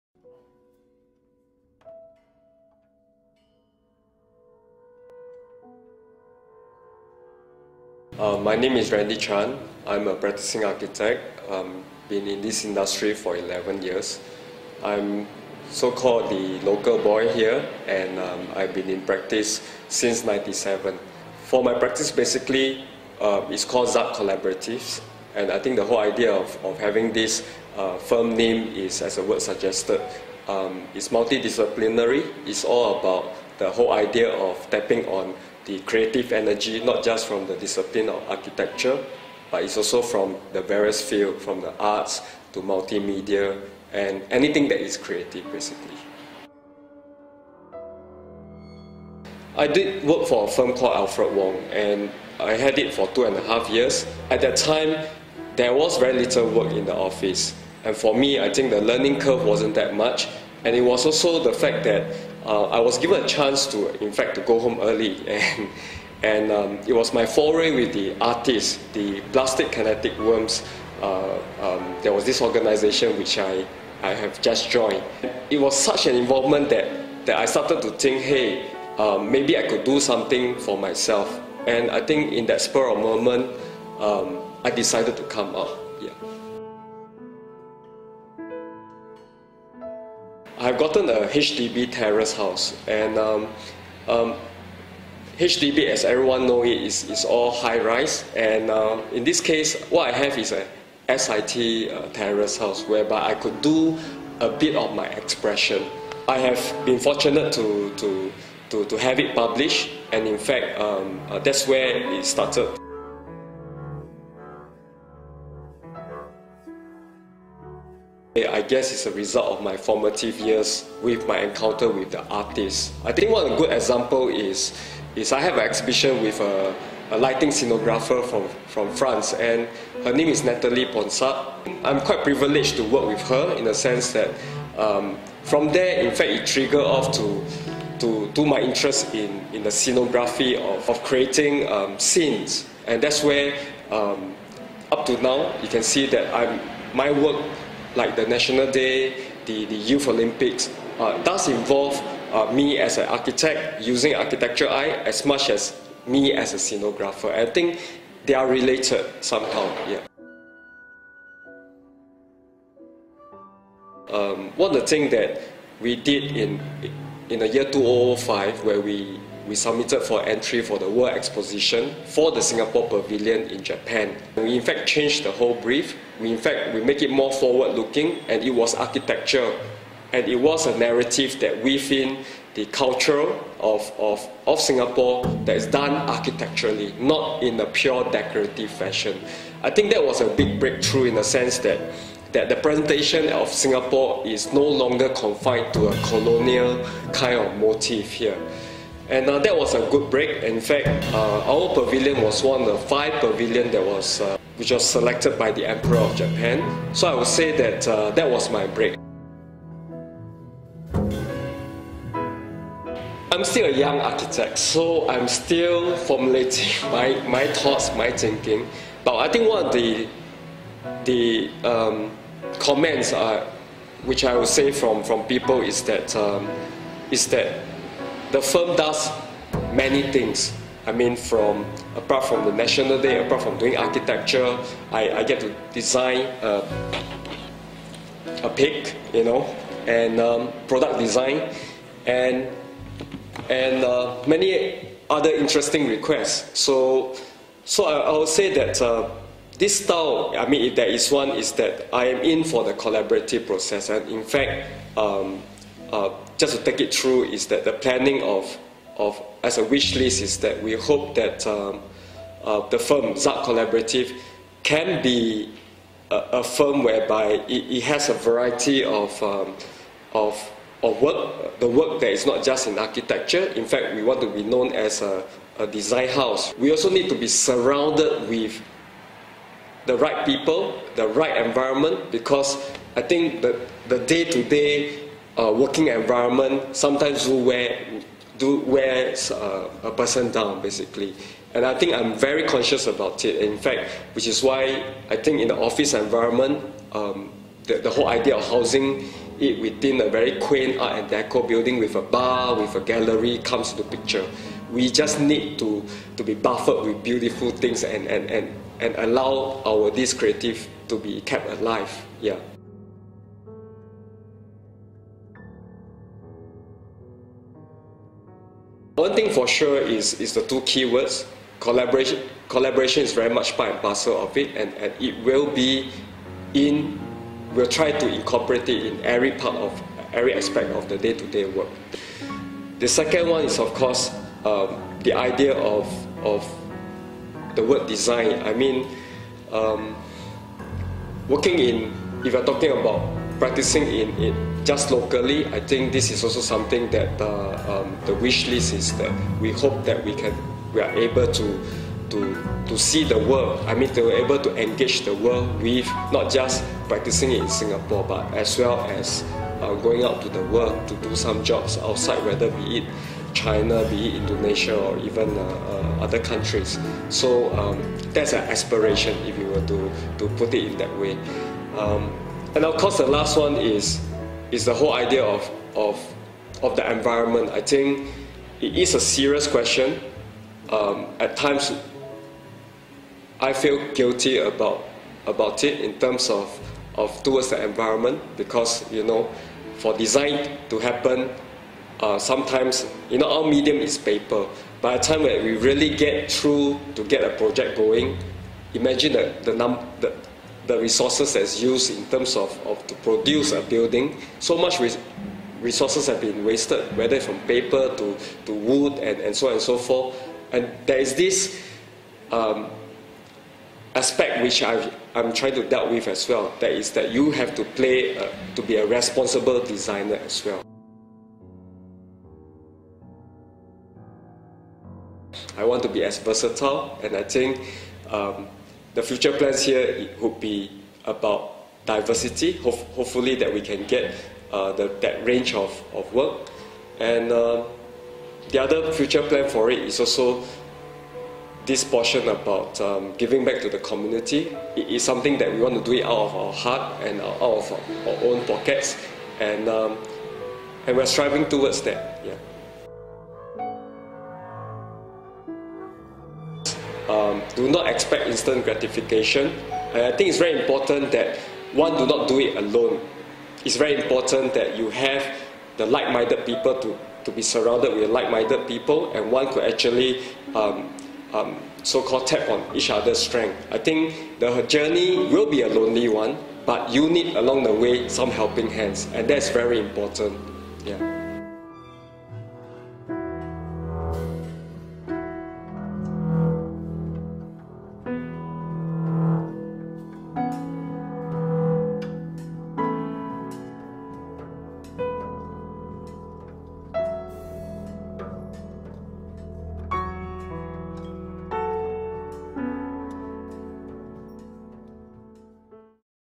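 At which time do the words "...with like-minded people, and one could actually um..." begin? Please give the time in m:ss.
7:47.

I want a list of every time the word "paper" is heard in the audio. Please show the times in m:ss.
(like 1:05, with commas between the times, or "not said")
6:33, 6:47.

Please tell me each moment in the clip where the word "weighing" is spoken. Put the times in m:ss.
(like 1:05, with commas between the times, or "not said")
not said.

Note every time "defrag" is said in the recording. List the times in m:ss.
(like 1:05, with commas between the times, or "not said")
not said.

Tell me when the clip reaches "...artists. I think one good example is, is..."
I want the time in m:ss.
2:02.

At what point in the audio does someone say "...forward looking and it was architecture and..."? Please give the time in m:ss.
2:57.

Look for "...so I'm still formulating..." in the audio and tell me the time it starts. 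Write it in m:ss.
3:34.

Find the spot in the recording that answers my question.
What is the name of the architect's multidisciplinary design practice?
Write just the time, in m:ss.
0:23.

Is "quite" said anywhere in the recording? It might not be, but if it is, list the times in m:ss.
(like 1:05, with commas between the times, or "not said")
2:11.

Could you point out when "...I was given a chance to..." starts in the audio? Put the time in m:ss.
1:02.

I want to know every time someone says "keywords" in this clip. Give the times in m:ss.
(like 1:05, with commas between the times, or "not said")
5:20.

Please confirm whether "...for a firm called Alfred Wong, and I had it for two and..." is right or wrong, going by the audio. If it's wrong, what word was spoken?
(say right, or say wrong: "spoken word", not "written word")
right.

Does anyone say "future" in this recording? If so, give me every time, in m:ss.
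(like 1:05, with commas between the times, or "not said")
7:09, 7:18.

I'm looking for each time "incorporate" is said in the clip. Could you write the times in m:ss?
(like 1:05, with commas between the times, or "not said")
5:28.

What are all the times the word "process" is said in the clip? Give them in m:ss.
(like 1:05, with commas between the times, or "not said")
4:13.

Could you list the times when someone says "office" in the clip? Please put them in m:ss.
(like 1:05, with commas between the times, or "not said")
0:56, 4:55.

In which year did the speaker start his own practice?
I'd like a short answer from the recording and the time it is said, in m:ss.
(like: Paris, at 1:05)
1997, at 0:20.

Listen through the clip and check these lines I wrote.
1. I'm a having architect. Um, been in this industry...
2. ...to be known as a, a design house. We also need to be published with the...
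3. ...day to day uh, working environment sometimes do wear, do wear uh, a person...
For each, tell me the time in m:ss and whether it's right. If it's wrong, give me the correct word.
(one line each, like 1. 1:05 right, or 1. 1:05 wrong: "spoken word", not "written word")
1. 0:09 wrong: "practicing", not "having"
2. 4:34 wrong: "surrounded", not "published"
3. 4:43 right.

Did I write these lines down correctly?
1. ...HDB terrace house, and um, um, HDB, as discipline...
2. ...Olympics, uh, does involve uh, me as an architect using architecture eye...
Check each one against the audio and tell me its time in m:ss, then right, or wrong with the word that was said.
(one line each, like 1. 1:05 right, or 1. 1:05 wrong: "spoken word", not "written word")
1. 1:31 wrong: "everyone", not "discipline"
2. 2:30 right.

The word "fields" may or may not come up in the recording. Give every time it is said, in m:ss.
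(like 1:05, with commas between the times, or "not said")
0:41.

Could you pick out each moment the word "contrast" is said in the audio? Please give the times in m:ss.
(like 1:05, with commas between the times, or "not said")
not said.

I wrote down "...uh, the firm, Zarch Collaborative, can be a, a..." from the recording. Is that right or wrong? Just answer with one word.
right.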